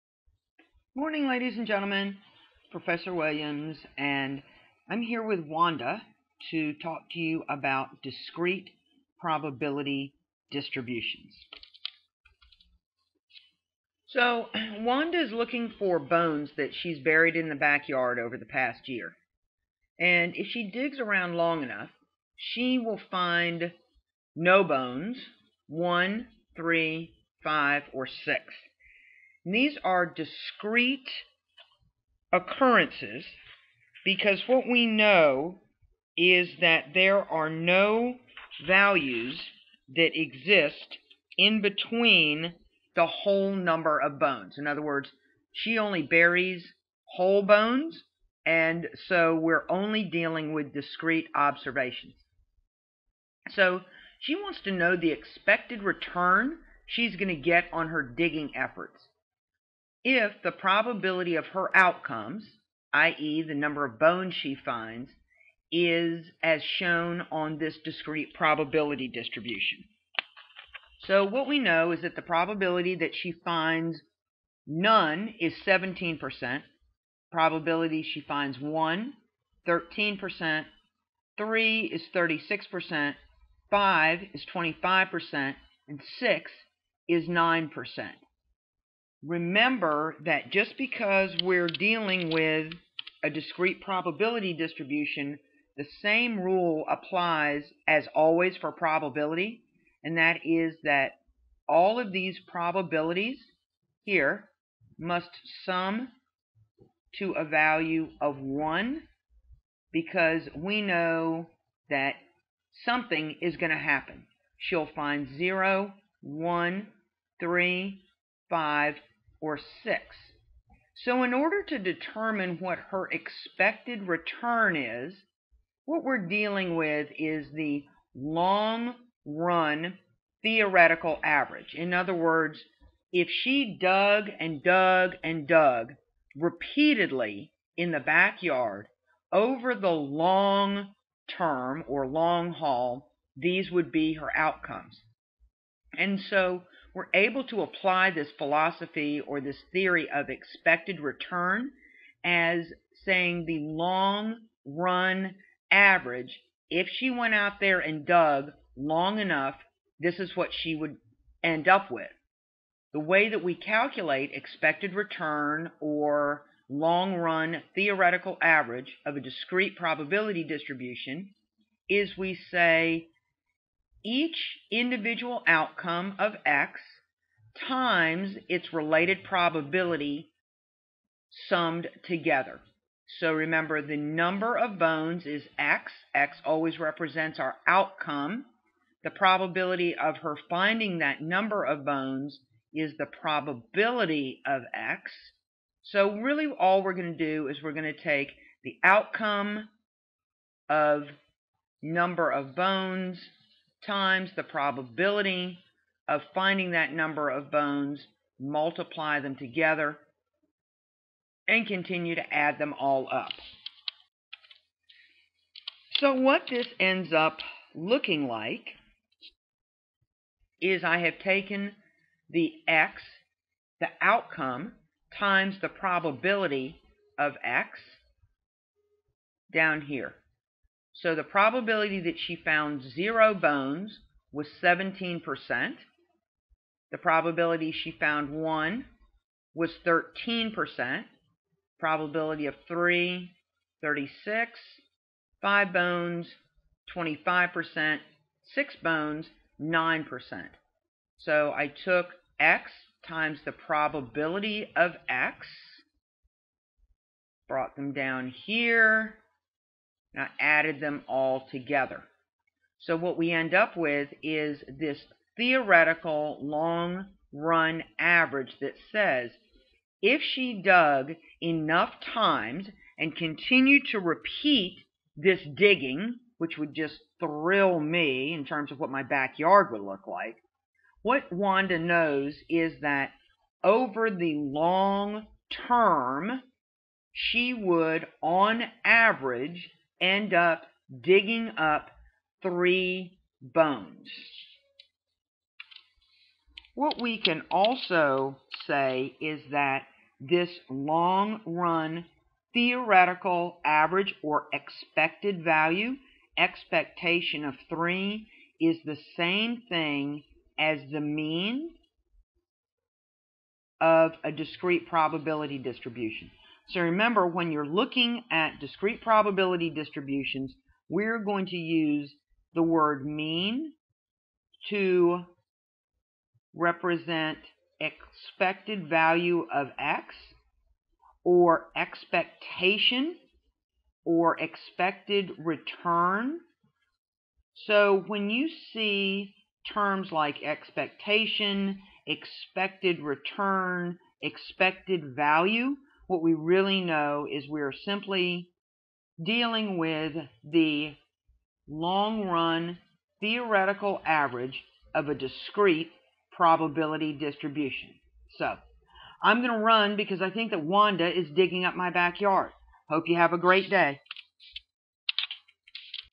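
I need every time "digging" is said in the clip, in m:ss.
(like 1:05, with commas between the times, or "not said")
0:58, 4:35, 4:51, 6:01.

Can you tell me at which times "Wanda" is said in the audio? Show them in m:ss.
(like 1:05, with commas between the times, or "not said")
0:05, 0:14, 4:41, 6:00.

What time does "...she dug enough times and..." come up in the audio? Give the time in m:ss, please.
4:30.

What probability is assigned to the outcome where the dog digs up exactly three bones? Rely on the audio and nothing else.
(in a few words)
36%.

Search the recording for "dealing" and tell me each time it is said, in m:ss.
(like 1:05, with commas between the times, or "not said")
0:50, 1:31, 2:06, 5:49.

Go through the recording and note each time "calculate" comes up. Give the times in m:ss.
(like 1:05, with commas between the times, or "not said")
2:43.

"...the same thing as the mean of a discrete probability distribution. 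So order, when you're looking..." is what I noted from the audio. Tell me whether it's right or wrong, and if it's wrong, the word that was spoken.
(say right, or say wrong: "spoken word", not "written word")
wrong: "remember", not "order".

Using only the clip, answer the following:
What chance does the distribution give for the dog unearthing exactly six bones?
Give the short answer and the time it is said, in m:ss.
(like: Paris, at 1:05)
9%, at 1:26.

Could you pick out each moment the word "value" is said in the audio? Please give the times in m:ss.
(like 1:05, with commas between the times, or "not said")
0:38, 1:47, 5:05, 5:28, 5:45.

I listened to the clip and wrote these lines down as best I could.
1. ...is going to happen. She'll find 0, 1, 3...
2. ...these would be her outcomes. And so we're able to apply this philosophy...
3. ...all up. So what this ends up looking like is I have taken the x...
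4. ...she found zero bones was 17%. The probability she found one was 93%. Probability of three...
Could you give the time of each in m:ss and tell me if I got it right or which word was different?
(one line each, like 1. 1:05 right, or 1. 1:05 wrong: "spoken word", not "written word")
1. 1:53 right
2. 2:23 right
3. 3:32 right
4. 3:52 wrong: "13", not "93".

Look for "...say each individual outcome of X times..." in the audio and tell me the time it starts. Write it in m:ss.
2:52.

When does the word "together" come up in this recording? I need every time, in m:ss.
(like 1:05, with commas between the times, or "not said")
3:02, 3:29, 4:21.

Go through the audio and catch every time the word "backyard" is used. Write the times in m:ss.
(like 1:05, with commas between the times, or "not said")
0:17, 2:17, 4:39, 6:01.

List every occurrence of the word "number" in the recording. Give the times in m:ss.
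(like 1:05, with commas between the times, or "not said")
0:43, 1:03, 3:03, 3:11, 3:21, 3:26.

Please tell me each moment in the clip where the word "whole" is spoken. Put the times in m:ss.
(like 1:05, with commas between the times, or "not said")
0:43, 0:47.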